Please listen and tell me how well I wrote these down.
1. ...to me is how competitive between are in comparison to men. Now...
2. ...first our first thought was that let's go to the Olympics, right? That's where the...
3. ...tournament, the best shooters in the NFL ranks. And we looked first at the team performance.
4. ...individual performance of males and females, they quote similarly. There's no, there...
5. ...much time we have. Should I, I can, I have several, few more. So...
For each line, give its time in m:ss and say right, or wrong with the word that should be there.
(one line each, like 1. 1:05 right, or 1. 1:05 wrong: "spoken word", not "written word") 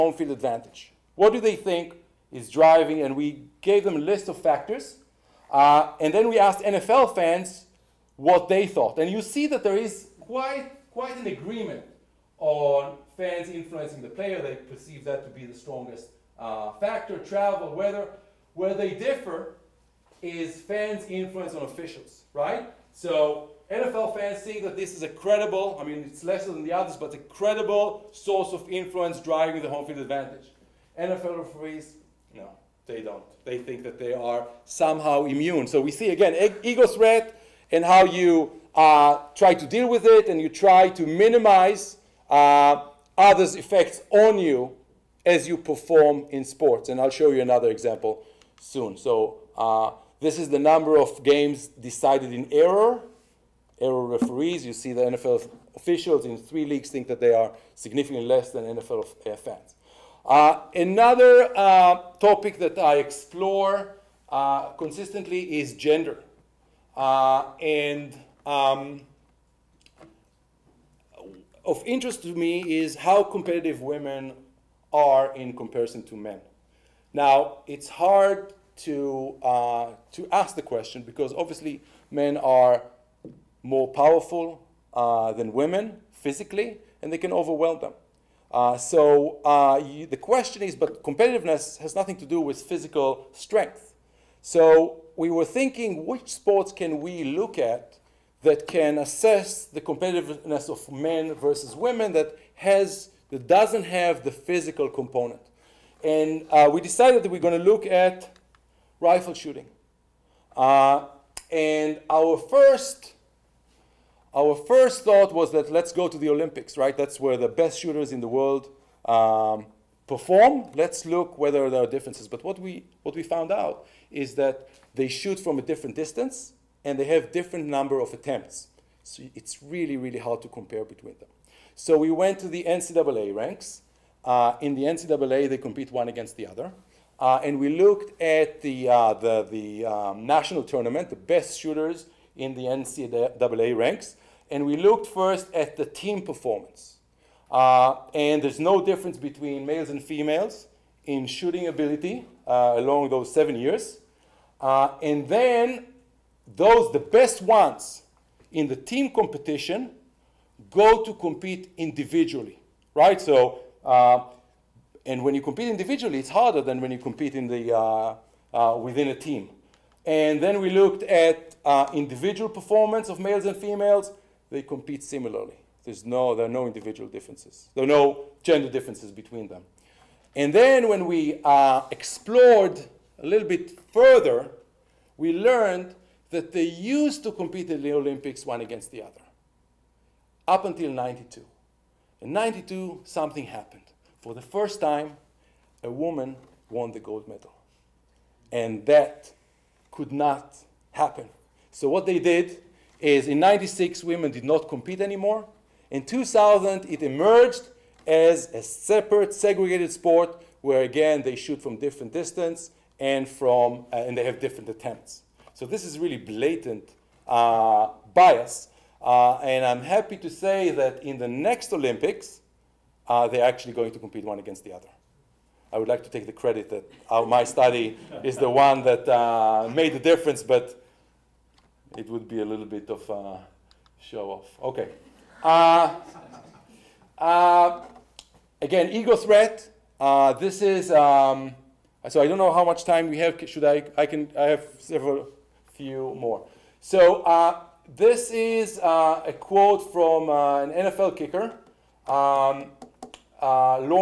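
1. 1:12 wrong: "women", not "between"
2. 1:52 right
3. 2:20 wrong: "NCAA", not "NFL"
4. 2:51 wrong: "compete", not "quote"
5. 4:02 right.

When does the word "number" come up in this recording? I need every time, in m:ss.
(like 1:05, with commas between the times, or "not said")
0:50, 2:07.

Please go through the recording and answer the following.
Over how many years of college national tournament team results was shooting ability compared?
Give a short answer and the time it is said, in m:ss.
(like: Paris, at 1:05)
7, at 2:33.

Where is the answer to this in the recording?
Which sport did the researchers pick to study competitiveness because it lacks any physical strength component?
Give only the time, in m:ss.
1:48.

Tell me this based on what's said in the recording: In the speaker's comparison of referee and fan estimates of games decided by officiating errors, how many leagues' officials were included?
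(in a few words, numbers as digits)
3.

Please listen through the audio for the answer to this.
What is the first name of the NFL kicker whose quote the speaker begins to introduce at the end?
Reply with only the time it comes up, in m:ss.
4:13.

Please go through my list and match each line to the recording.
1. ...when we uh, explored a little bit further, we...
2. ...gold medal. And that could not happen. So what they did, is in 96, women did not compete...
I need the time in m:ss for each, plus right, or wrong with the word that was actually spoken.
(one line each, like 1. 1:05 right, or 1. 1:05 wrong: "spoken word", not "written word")
1. 3:00 right
2. 3:16 right.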